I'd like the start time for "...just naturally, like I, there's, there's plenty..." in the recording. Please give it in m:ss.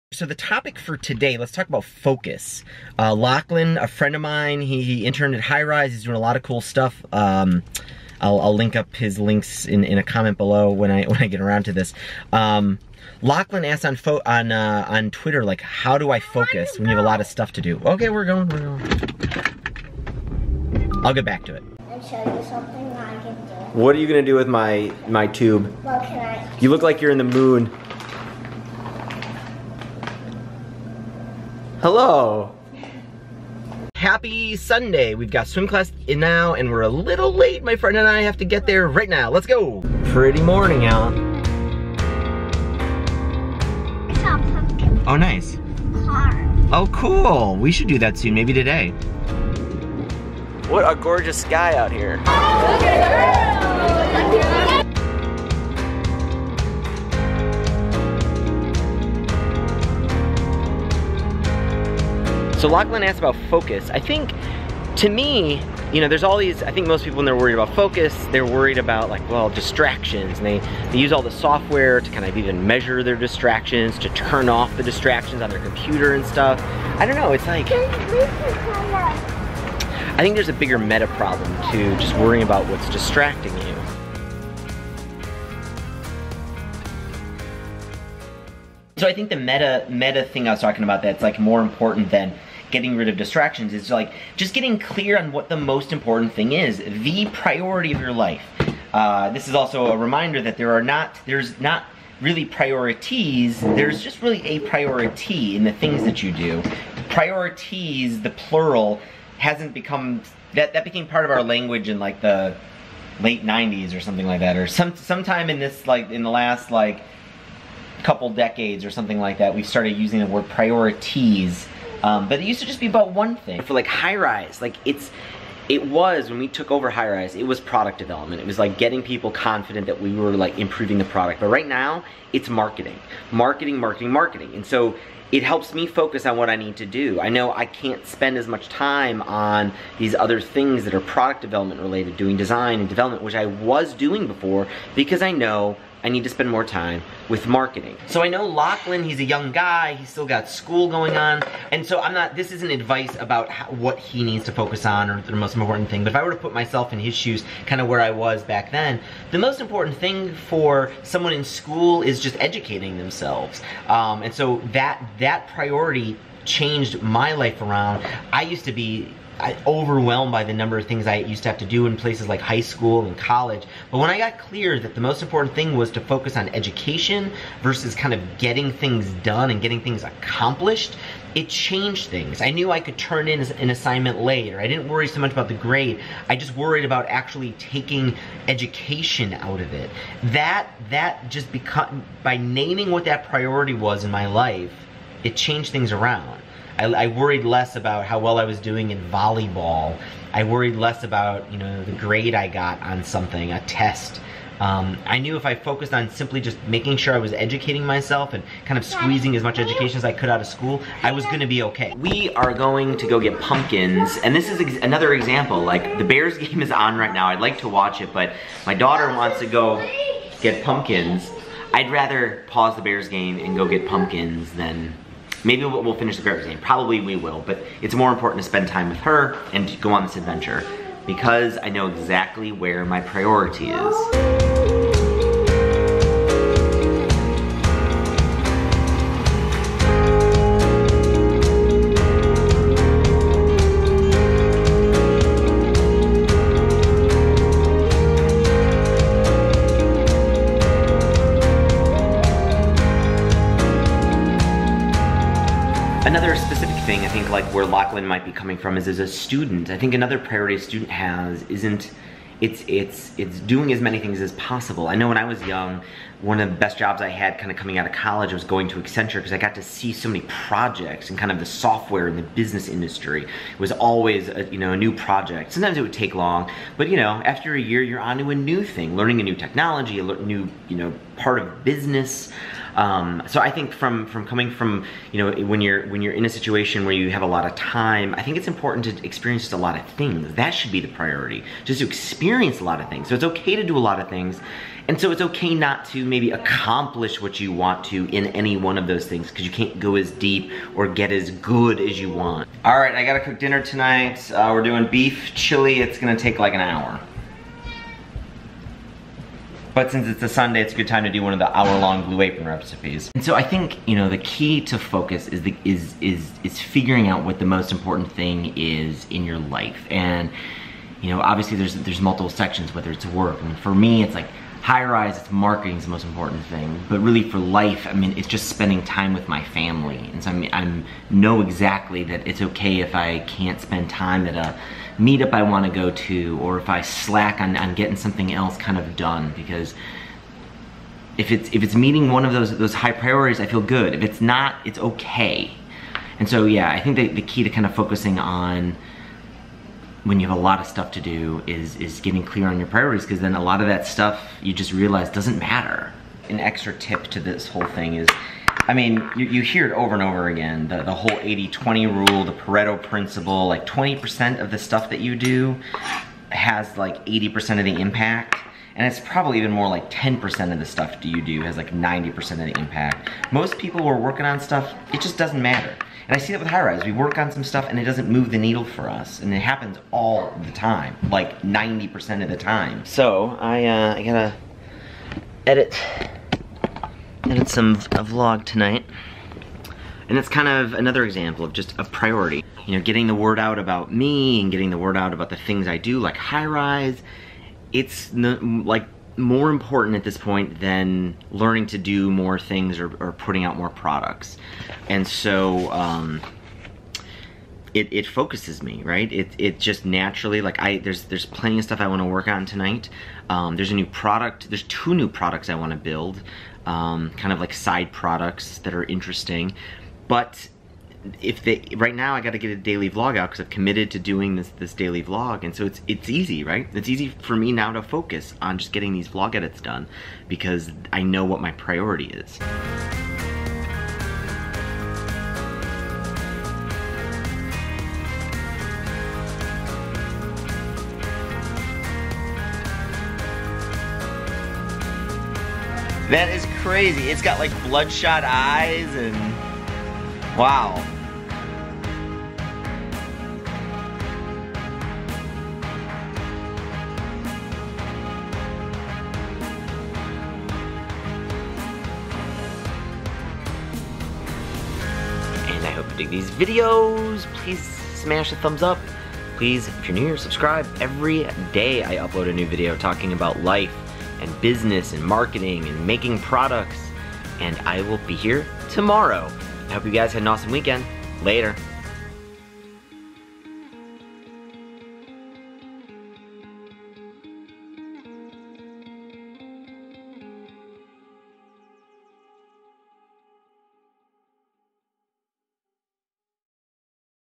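6:49.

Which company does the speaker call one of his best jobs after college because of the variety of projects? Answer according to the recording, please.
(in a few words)
Accenture.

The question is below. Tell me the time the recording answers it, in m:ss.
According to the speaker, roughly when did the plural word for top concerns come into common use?
1:53.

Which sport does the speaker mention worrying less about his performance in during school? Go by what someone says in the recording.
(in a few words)
volleyball.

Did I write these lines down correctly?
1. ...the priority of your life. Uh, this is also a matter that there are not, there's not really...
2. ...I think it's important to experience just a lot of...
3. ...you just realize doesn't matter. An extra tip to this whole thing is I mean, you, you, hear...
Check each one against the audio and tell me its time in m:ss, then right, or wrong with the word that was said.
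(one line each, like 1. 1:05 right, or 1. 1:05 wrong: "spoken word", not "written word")
1. 1:36 wrong: "reminder", not "matter"
2. 4:48 right
3. 5:54 right.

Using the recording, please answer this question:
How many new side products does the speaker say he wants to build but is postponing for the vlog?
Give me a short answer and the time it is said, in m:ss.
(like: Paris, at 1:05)
2, at 6:54.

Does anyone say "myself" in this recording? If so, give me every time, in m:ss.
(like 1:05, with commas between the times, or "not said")
2:36, 3:27.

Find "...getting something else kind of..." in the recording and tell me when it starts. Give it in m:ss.
5:37.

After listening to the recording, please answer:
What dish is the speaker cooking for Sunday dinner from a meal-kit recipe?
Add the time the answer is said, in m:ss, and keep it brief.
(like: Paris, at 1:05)
beef chili, at 5:04.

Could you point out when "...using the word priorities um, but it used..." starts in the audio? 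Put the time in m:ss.
1:59.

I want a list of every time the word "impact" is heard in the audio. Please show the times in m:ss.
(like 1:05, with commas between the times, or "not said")
6:07, 6:12.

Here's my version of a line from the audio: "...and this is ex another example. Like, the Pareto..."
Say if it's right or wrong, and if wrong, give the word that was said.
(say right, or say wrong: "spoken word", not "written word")
wrong: "Bears", not "Pareto".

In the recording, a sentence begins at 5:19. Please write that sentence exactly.
And, you know, obviously there's, there's multiple sections, whether it's work.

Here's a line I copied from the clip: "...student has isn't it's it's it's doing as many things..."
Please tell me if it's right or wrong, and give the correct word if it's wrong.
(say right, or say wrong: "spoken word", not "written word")
right.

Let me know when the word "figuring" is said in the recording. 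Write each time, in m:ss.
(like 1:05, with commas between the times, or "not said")
5:16.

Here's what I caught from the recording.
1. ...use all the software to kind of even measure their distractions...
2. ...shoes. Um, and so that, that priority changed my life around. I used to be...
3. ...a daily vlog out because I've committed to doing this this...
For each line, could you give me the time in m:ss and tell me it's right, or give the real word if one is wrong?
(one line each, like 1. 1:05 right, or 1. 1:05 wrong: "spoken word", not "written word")
1. 1:10 right
2. 2:42 wrong: "themselves", not "shoes"
3. 7:02 right.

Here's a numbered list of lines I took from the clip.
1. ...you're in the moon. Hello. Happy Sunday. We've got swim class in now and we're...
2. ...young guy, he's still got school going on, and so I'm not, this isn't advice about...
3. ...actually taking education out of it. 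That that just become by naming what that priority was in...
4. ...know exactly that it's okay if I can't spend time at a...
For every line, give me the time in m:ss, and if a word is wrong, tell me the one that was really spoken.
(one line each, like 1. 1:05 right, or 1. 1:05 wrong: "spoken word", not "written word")
1. 0:27 right
2. 2:29 right
3. 3:07 right
4. 5:31 right.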